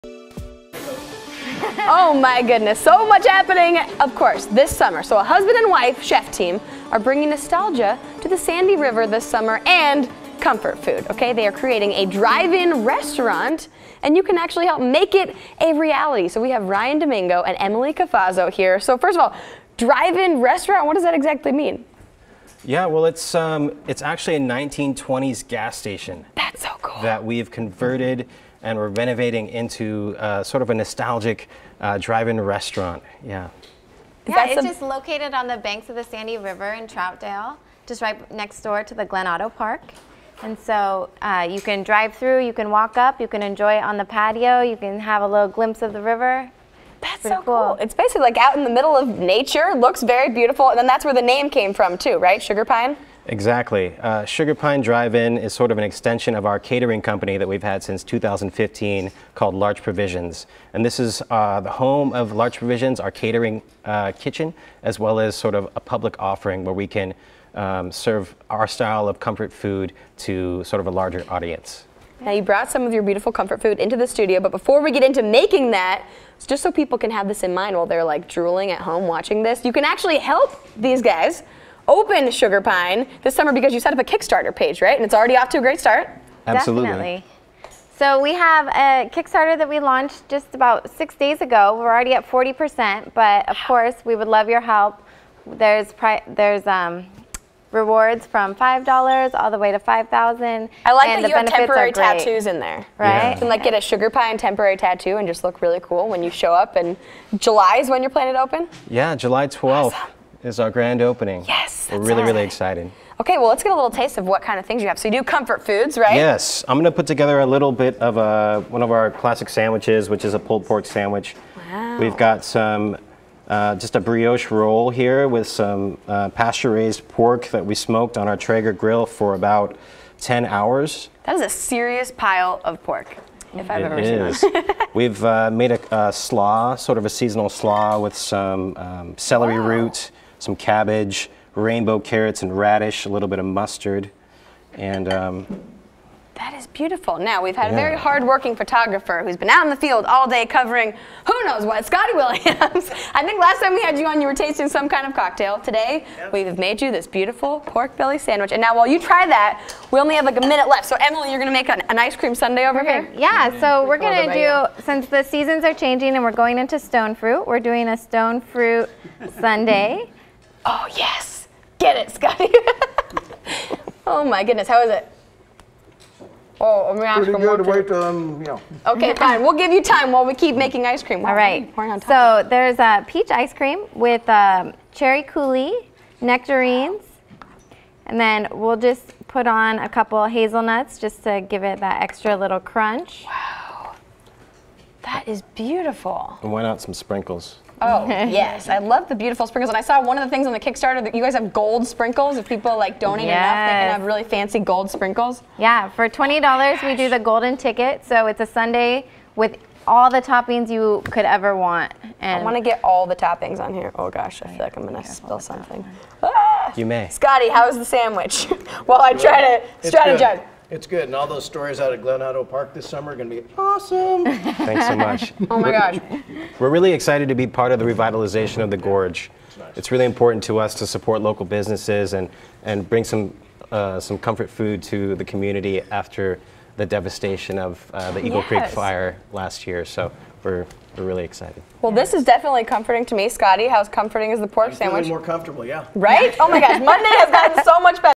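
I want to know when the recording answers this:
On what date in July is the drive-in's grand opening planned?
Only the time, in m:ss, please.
1:49.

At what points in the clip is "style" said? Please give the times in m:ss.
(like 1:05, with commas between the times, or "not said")
1:08.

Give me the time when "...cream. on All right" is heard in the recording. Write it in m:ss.
3:01.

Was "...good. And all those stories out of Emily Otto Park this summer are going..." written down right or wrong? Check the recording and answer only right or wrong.
wrong.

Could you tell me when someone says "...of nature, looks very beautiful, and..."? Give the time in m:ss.
0:48.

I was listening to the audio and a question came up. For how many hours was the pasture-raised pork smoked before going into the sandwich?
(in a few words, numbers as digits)
10 hours.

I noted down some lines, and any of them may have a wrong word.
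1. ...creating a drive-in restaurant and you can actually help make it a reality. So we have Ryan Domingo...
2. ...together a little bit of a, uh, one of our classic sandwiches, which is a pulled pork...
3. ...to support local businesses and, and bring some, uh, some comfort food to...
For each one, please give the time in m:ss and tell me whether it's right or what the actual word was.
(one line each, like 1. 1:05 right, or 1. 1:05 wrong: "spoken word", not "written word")
1. 0:11 right
2. 1:57 right
3. 3:50 right.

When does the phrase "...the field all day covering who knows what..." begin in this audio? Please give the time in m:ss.
2:29.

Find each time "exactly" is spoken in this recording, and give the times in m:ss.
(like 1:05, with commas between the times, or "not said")
0:21, 0:53.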